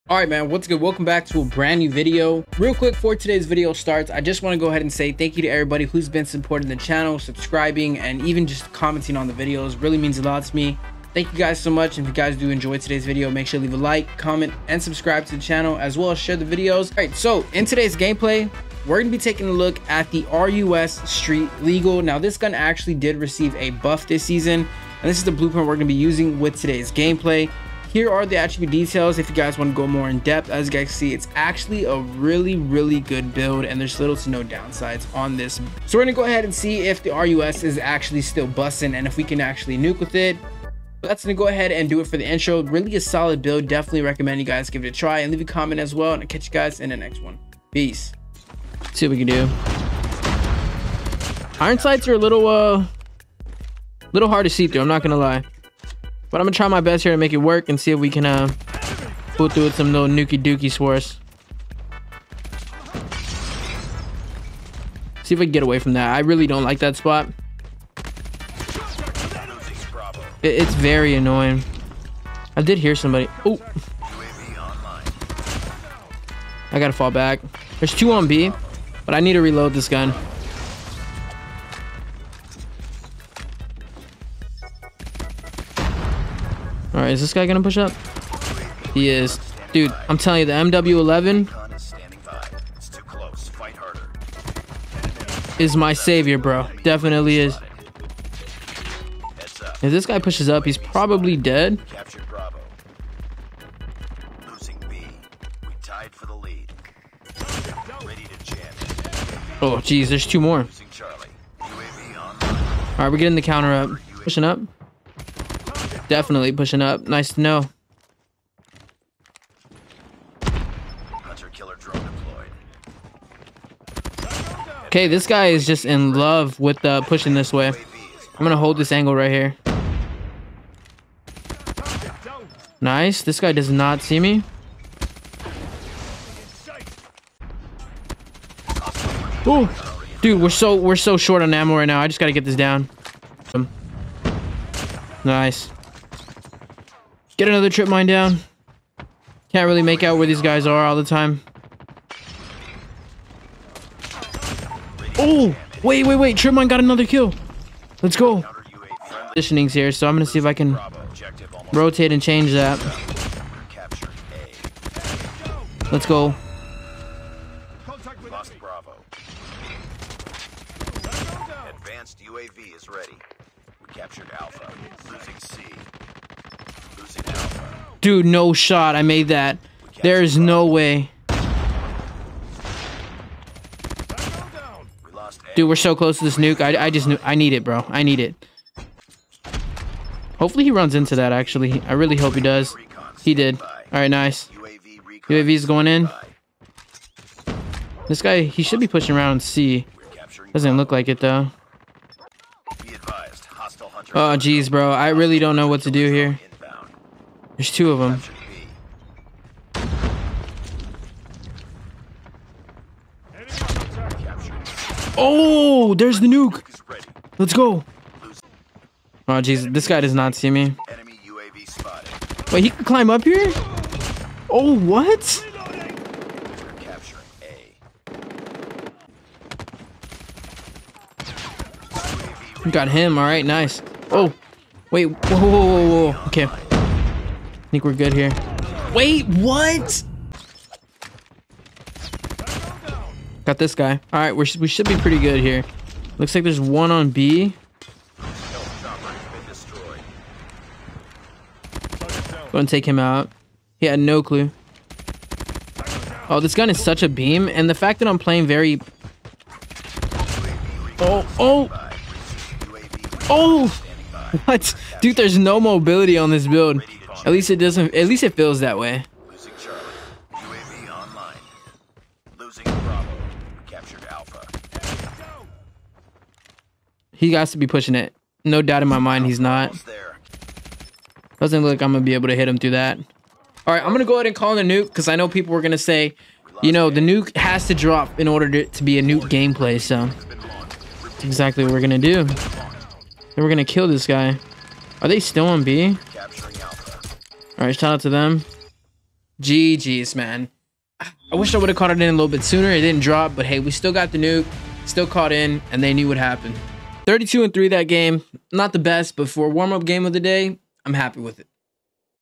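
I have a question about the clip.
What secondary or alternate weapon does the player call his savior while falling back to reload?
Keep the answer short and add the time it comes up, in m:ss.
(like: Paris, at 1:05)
MW11, at 1:30.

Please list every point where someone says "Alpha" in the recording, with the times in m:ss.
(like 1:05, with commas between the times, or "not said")
2:54, 4:34.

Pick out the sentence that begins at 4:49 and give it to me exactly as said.
So that's exactly what we're gonna do.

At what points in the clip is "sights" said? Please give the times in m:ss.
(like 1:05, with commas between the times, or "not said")
0:51.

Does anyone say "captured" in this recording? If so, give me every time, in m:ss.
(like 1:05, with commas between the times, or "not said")
2:53, 4:33.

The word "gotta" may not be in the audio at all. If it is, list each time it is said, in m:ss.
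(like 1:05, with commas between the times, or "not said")
1:16, 2:22.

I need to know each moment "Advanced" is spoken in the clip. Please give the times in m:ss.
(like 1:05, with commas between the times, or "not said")
2:51.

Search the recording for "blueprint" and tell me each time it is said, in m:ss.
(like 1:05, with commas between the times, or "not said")
0:25.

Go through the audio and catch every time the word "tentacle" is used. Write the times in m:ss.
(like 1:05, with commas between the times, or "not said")
not said.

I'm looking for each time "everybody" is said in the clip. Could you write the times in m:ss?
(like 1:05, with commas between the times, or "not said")
0:05.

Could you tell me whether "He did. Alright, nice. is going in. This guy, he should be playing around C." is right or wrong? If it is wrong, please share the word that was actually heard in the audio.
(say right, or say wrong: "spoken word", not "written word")
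wrong: "pushing", not "playing".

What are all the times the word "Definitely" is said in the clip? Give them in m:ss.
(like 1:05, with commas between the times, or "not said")
0:43, 1:36, 1:56.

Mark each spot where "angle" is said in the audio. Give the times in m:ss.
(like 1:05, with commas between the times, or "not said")
2:08.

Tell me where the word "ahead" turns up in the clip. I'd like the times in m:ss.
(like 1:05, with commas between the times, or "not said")
0:04, 0:36, 0:41, 4:44.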